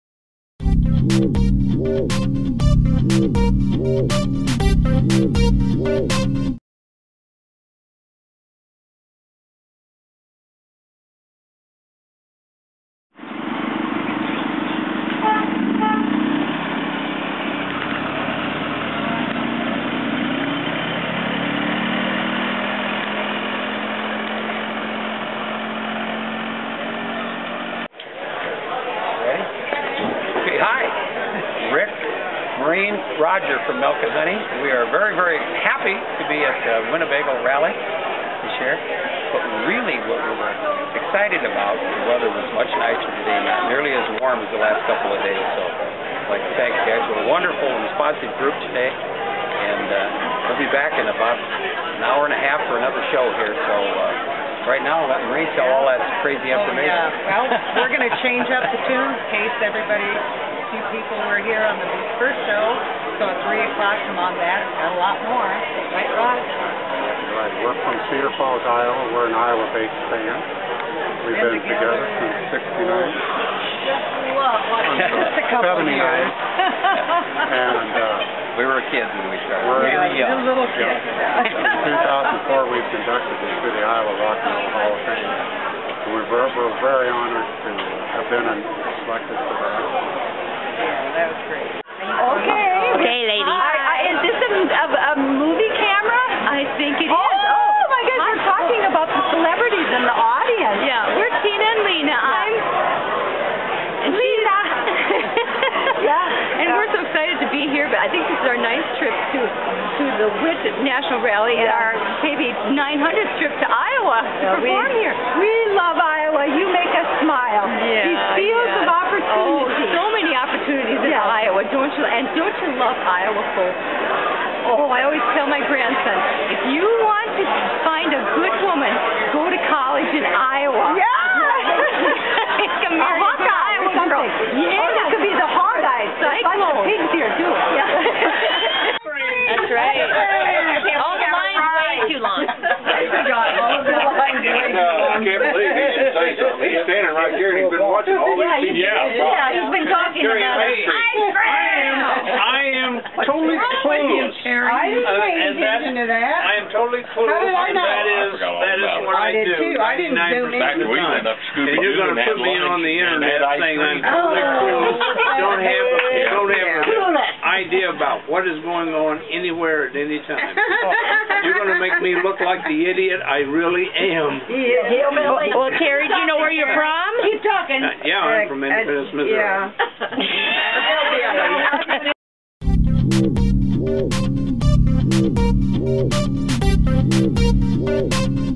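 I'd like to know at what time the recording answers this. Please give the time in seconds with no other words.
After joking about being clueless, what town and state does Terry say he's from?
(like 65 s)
178 s.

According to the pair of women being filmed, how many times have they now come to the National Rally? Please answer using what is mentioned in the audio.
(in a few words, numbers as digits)
9th trip.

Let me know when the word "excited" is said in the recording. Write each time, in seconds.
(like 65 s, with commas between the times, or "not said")
40 s, 107 s.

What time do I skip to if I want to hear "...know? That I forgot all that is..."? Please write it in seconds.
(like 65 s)
157 s.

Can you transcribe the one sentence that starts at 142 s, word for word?
I can't believe he He's standing right here and he's been watching all these Yeah, yeah he's been talking about it.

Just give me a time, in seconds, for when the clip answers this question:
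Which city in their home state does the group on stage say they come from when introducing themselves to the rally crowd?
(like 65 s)
68 s.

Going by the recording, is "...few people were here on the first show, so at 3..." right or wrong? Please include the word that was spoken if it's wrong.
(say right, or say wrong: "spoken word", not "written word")
right.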